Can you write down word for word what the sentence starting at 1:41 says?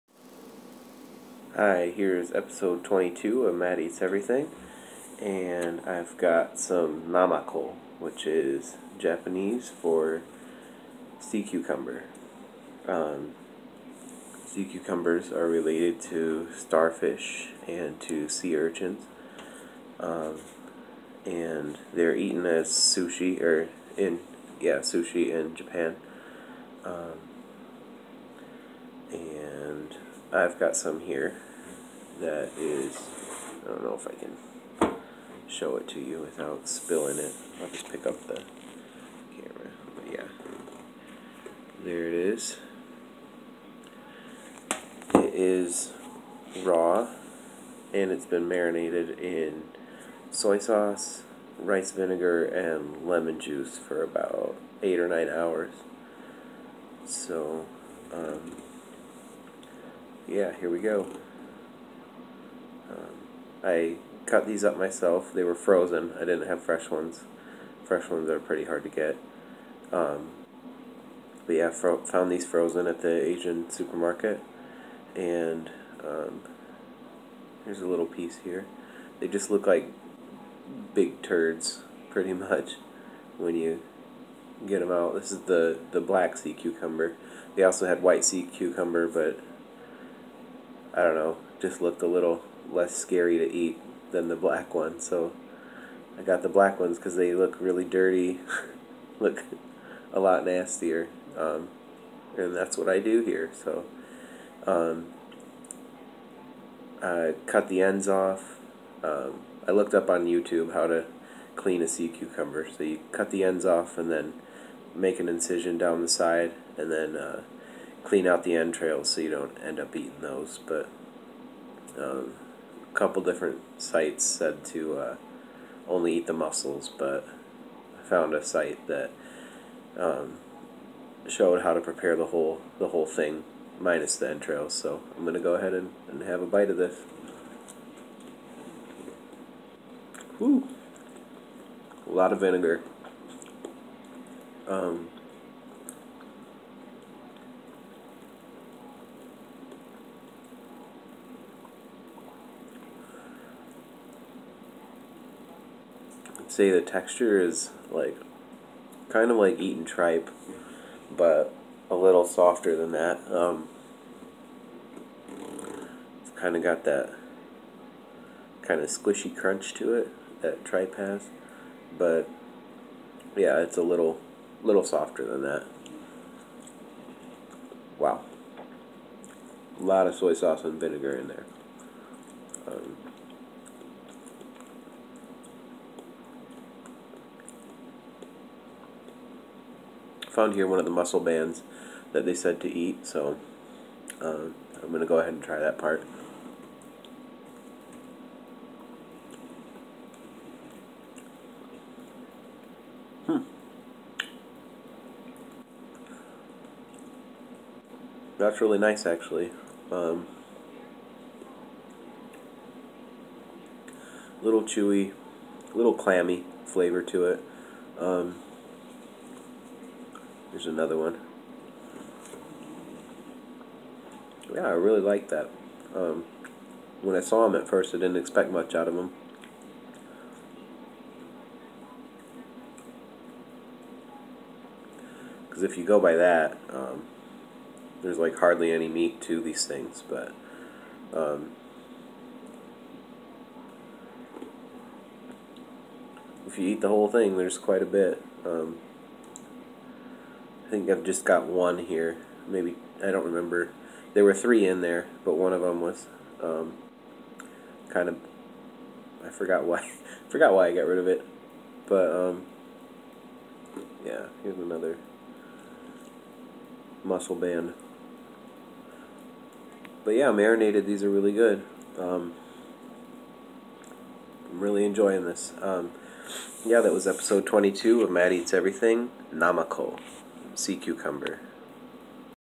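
Um, and that's what I do here.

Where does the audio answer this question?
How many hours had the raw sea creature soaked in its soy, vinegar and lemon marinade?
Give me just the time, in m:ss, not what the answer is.
0:54.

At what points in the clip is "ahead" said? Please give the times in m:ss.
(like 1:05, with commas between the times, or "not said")
2:15, 3:15.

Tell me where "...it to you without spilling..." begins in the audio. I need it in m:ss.
0:35.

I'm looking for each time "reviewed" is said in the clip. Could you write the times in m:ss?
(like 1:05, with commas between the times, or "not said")
not said.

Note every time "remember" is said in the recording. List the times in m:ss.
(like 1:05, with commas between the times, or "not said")
4:13.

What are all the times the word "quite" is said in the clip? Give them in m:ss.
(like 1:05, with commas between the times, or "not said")
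4:07.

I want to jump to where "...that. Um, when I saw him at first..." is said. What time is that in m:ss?
3:45.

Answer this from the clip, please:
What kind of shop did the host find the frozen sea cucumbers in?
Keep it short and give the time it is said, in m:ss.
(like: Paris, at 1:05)
Asian supermarket, at 1:13.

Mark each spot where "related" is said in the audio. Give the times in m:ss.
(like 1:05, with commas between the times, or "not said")
0:15.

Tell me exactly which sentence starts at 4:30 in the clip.
But yeah, marinated, these are really good.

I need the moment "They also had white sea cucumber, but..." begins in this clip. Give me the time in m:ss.
1:27.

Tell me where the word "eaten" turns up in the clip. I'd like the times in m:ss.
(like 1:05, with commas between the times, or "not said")
0:22, 2:39.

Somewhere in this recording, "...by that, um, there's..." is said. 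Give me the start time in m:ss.
3:56.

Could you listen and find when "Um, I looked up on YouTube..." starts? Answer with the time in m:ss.
1:49.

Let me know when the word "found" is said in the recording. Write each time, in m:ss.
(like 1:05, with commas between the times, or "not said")
1:11, 2:08, 3:10.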